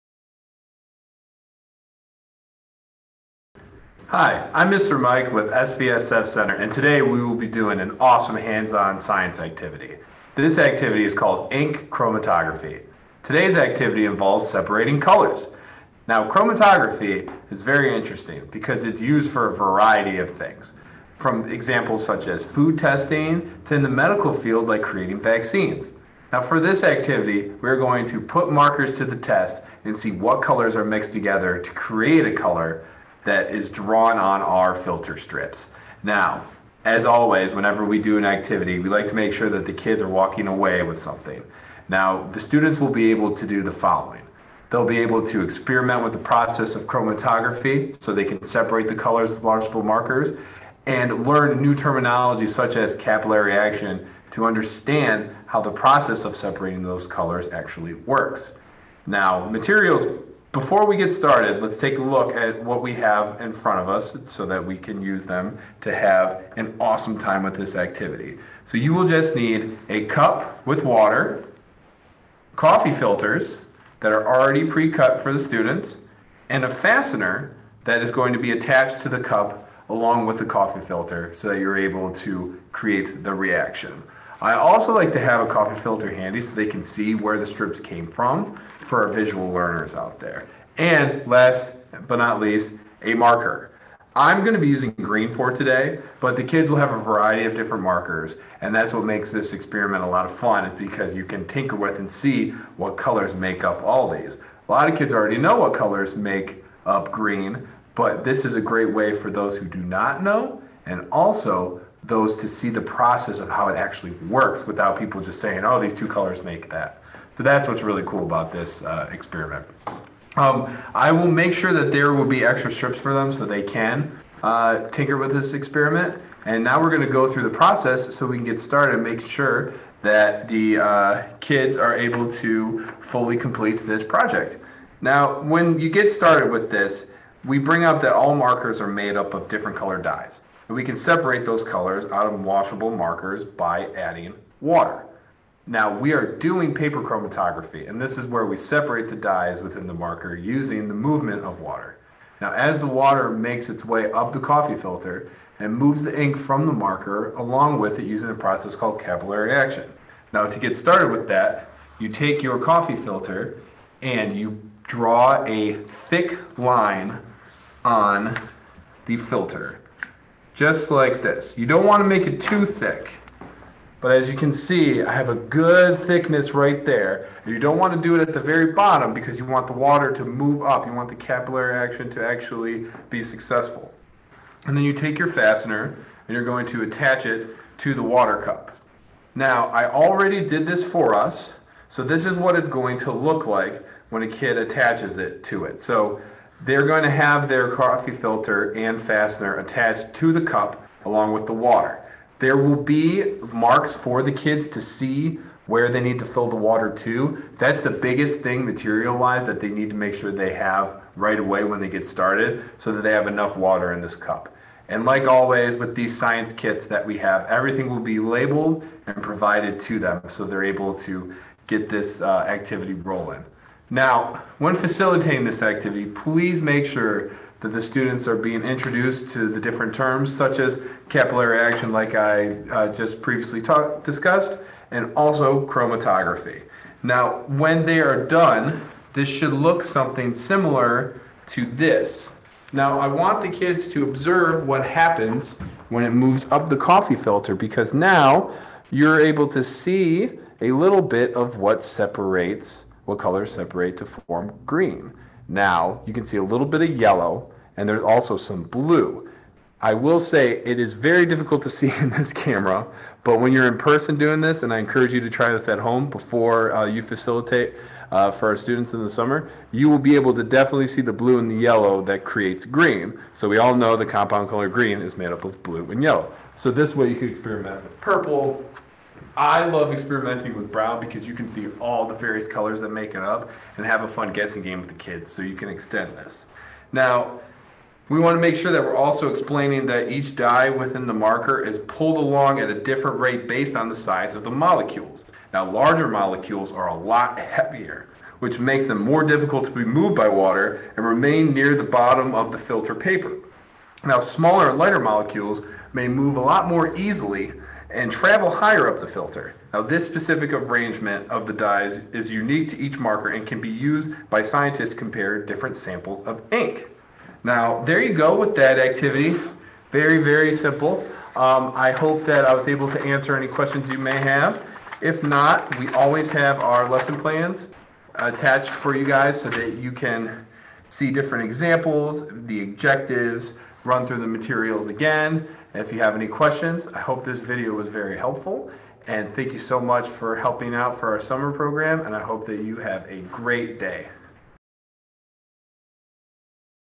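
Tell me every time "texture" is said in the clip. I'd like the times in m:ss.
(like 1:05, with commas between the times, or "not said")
not said.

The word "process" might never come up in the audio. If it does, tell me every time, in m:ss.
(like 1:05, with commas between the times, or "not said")
0:46, 0:55, 1:52, 2:07, 2:38.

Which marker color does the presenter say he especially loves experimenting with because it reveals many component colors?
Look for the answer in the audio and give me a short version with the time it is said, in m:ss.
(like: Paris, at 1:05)
Brown, at 4:40.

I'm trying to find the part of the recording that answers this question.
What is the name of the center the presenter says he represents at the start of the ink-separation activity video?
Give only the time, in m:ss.
0:05.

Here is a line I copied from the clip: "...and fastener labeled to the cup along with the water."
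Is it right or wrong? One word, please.
wrong.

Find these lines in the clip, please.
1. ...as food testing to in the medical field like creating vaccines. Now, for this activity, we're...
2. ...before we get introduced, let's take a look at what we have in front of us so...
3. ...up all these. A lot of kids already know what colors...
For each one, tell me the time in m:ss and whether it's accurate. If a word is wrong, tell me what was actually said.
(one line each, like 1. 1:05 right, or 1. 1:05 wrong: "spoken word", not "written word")
1. 0:22 right
2. 1:00 wrong: "started", not "introduced"
3. 1:43 right.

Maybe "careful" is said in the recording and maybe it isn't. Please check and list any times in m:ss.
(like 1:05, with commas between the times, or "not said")
not said.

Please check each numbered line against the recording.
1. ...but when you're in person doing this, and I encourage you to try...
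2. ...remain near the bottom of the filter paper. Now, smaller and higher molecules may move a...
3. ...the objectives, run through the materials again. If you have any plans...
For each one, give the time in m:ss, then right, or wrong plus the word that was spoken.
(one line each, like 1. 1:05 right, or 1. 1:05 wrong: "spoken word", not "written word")
1. 4:23 right
2. 5:01 wrong: "lighter", not "higher"
3. 5:32 wrong: "questions", not "plans".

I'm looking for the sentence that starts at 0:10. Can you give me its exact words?
This activity is called ink chromatography.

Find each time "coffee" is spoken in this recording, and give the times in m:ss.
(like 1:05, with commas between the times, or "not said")
1:12, 1:20, 1:25, 2:34, 2:42, 3:17, 4:06.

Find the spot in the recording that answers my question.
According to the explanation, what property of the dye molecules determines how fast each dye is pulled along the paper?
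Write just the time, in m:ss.
4:53.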